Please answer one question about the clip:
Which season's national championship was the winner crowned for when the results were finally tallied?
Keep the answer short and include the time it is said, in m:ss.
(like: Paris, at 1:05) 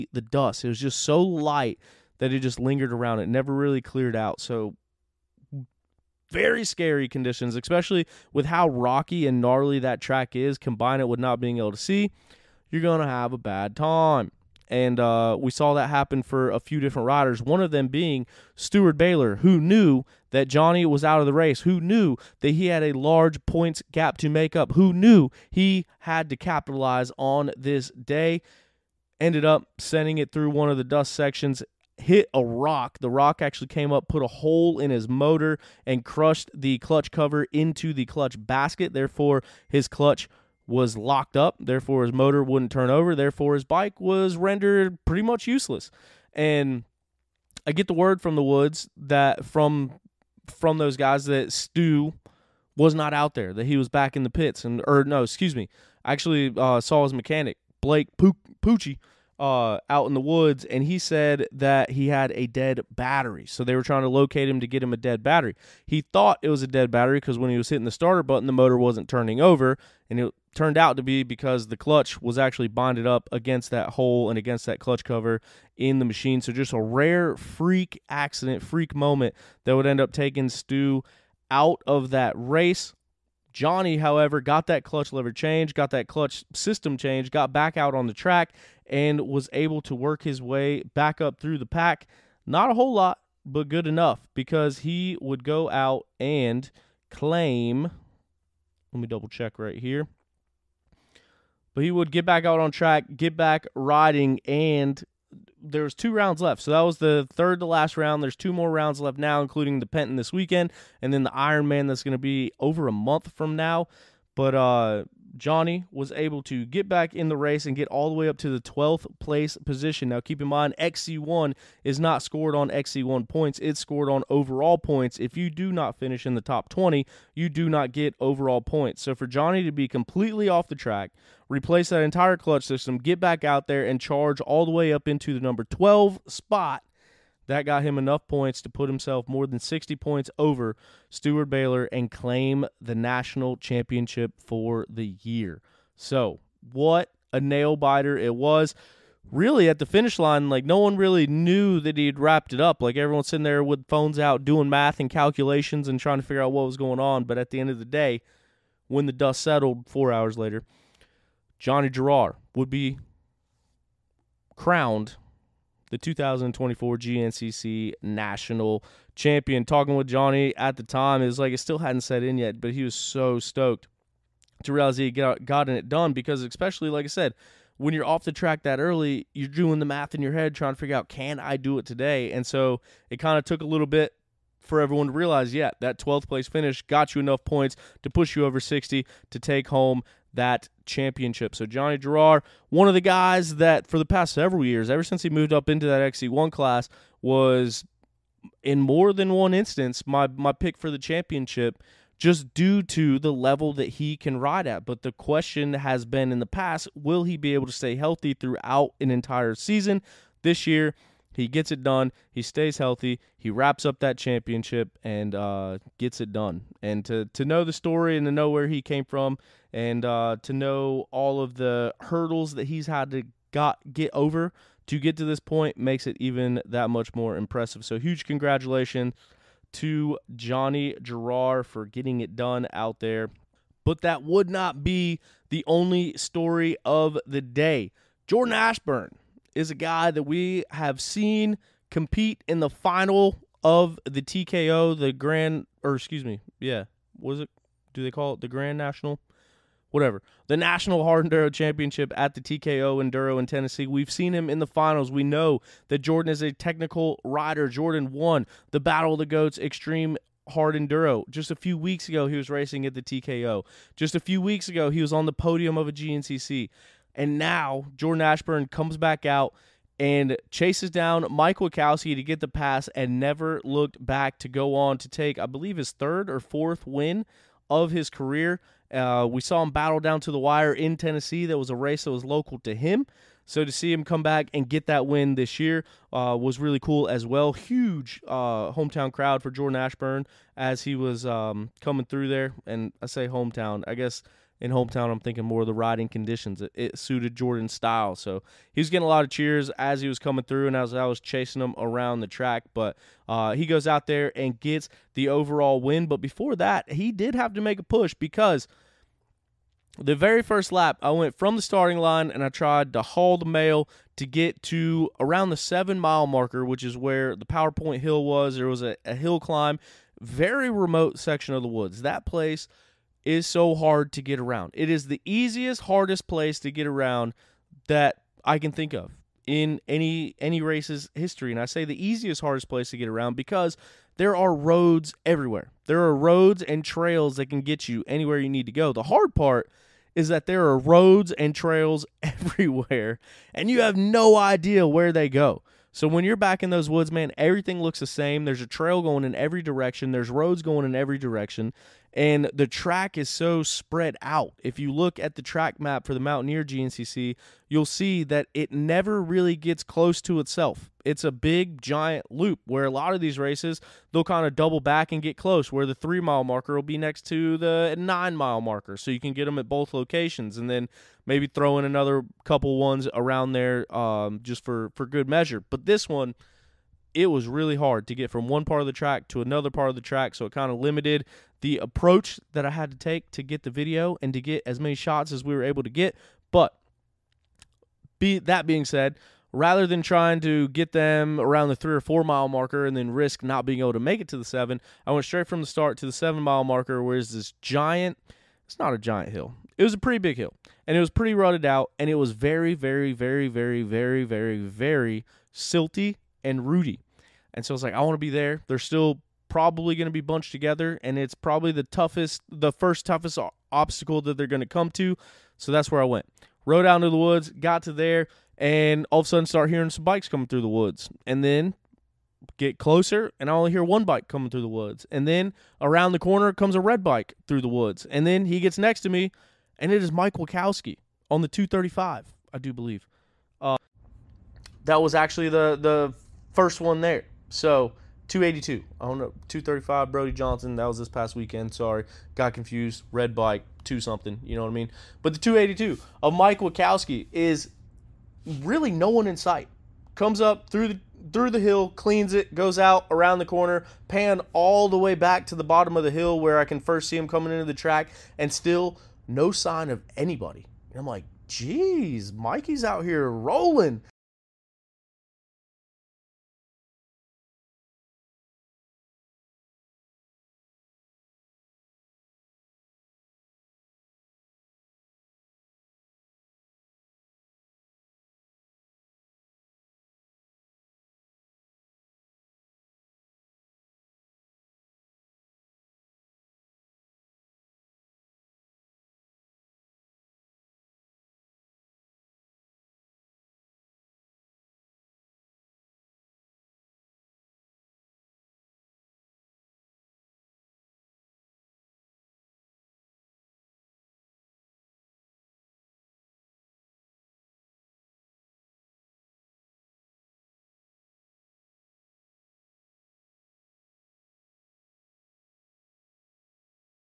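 2024, at 2:45.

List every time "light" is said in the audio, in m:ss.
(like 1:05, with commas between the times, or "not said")
0:01.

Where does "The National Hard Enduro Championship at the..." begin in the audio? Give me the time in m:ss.
4:10.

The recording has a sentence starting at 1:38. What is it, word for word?
Let me double check right here.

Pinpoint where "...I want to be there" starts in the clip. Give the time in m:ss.
6:47.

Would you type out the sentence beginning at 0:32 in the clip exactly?
The rock actually came up, put a hole in his motor, and crushed the clutch cover into the clutch basket.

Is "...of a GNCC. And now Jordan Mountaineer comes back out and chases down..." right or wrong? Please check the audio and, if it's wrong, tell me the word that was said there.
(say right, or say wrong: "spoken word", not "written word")
wrong: "Ashburn", not "Mountaineer".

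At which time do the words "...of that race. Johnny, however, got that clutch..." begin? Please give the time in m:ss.
1:21.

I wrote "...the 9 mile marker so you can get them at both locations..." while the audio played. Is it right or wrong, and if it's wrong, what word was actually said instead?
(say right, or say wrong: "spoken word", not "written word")
right.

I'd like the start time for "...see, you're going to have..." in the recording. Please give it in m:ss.
0:11.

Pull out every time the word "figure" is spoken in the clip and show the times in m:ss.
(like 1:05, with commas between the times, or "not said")
2:36, 3:00.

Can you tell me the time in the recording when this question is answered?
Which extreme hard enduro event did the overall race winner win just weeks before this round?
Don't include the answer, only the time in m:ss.
4:18.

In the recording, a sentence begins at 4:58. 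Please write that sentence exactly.
So he was getting a lot of cheers as he was coming through and as I was chasing him around the track.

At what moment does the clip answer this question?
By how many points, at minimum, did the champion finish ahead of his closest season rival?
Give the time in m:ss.
2:19.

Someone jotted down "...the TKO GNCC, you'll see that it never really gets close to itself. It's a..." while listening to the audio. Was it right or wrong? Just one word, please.
wrong.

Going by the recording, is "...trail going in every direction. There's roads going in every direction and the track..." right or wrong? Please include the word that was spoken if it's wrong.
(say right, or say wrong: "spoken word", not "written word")
right.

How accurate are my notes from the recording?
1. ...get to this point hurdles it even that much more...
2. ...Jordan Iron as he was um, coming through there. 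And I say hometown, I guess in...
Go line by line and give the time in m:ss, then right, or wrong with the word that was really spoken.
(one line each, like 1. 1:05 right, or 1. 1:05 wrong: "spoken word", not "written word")
1. 3:44 wrong: "makes", not "hurdles"
2. 4:49 wrong: "Ashburn", not "Iron".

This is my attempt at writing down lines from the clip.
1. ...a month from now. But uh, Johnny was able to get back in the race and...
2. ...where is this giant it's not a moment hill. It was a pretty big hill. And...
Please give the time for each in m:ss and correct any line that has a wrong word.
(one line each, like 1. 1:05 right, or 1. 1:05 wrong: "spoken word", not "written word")
1. 1:52 right
2. 6:37 wrong: "giant", not "moment".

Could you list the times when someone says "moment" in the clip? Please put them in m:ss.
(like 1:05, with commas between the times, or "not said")
1:18.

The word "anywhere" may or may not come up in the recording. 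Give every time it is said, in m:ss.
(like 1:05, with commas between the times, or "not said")
5:38.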